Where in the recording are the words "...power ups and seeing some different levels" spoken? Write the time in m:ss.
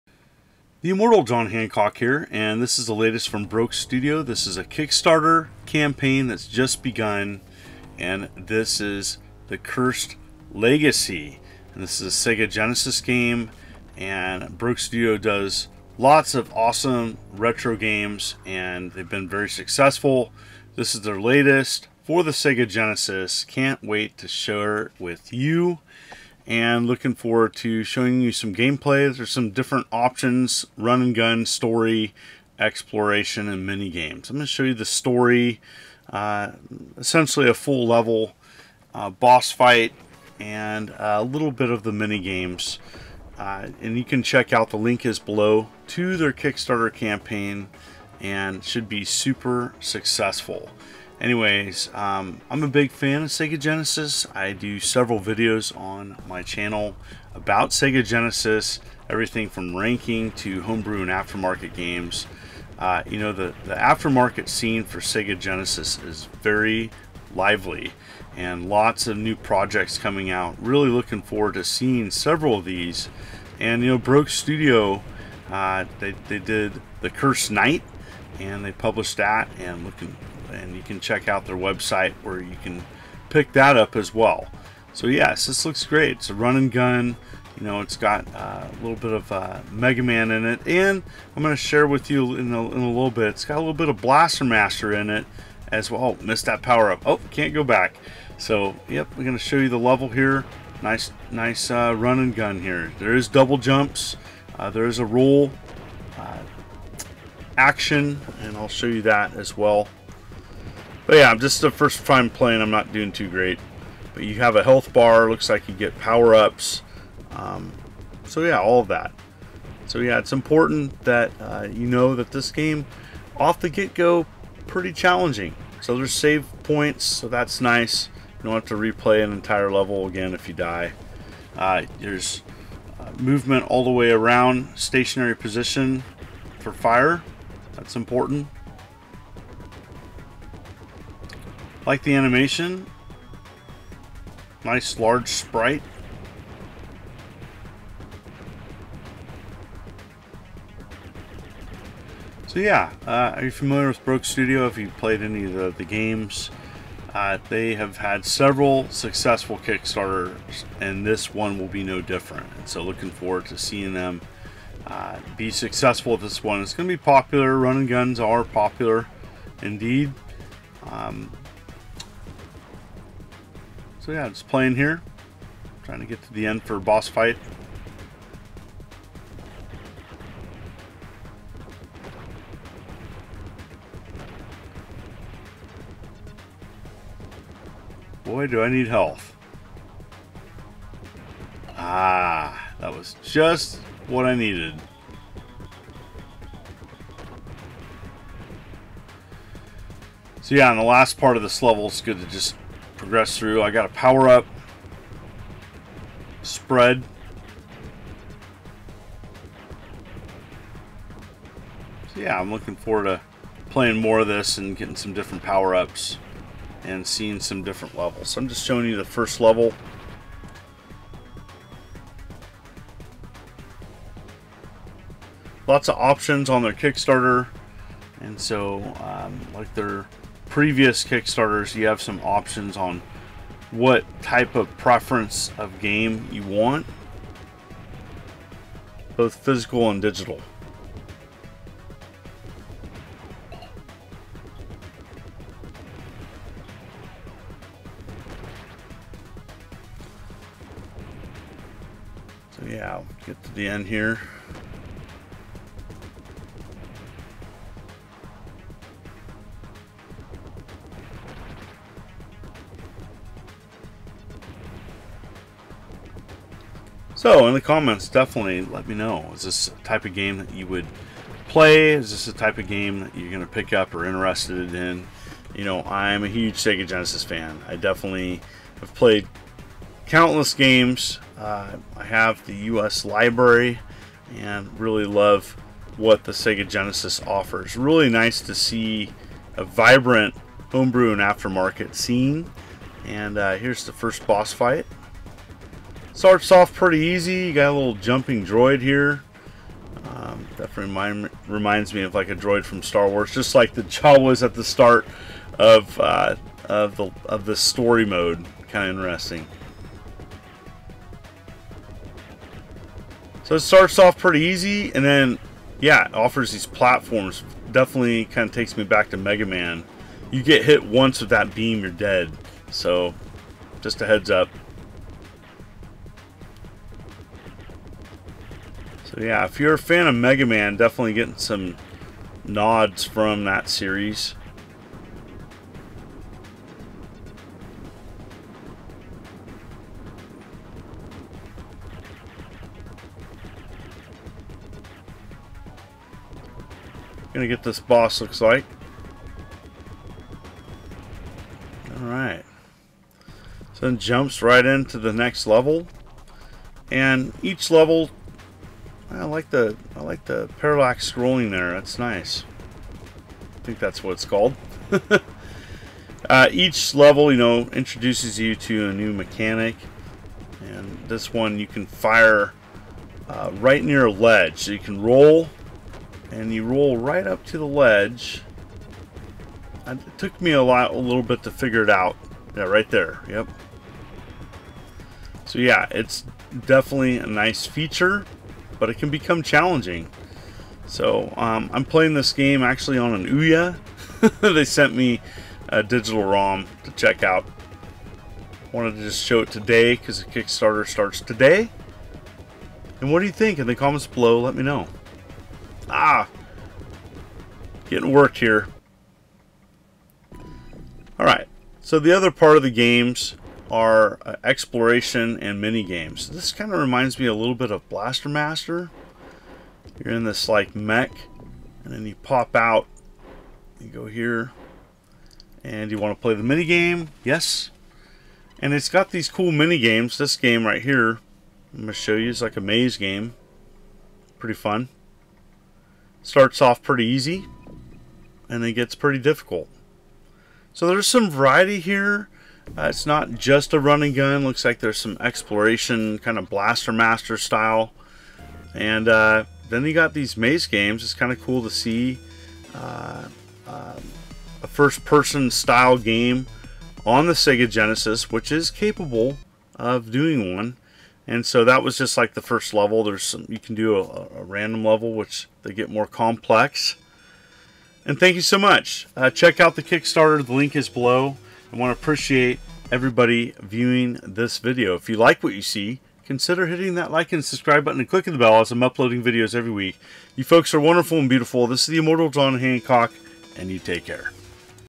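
3:35.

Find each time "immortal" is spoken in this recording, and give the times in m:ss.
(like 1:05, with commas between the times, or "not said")
0:00, 8:01.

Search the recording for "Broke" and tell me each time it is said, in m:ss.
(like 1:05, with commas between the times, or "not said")
0:03, 0:14, 1:13, 2:34.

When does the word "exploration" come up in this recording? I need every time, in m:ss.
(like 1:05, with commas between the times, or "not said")
0:32, 6:54, 7:25.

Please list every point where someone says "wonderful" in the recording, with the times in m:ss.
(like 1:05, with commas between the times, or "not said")
8:00.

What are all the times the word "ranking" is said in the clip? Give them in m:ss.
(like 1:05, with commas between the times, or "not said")
0:59.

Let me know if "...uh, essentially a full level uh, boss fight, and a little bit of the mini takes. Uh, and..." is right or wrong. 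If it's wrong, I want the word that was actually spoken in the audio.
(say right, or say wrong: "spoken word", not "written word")
wrong: "games", not "takes".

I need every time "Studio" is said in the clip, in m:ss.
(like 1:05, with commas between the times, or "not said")
0:03, 0:14, 1:14, 2:34.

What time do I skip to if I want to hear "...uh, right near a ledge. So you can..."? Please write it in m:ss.
6:13.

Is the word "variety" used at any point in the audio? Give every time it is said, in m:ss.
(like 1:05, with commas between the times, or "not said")
7:21.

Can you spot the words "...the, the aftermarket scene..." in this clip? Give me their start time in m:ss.
1:03.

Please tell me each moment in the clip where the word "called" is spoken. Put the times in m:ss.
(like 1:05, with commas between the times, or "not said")
6:04.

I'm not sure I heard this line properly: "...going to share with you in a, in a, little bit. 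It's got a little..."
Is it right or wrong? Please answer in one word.
right.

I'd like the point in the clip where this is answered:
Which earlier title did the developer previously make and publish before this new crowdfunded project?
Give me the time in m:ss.
1:17.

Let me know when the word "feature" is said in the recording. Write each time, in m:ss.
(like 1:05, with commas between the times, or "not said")
6:27.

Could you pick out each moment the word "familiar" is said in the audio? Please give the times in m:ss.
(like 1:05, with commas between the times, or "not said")
2:33.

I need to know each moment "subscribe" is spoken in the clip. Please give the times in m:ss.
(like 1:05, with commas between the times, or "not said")
7:57.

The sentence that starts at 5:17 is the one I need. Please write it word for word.
Definitely kind of takes me back to Mega Man.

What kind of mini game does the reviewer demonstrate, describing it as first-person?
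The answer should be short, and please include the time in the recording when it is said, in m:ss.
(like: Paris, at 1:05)
Maze game, at 7:12.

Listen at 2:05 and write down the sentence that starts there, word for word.
So there's save points, so that's nice.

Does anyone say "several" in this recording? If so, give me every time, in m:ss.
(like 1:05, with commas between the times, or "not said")
0:54, 1:12, 2:38.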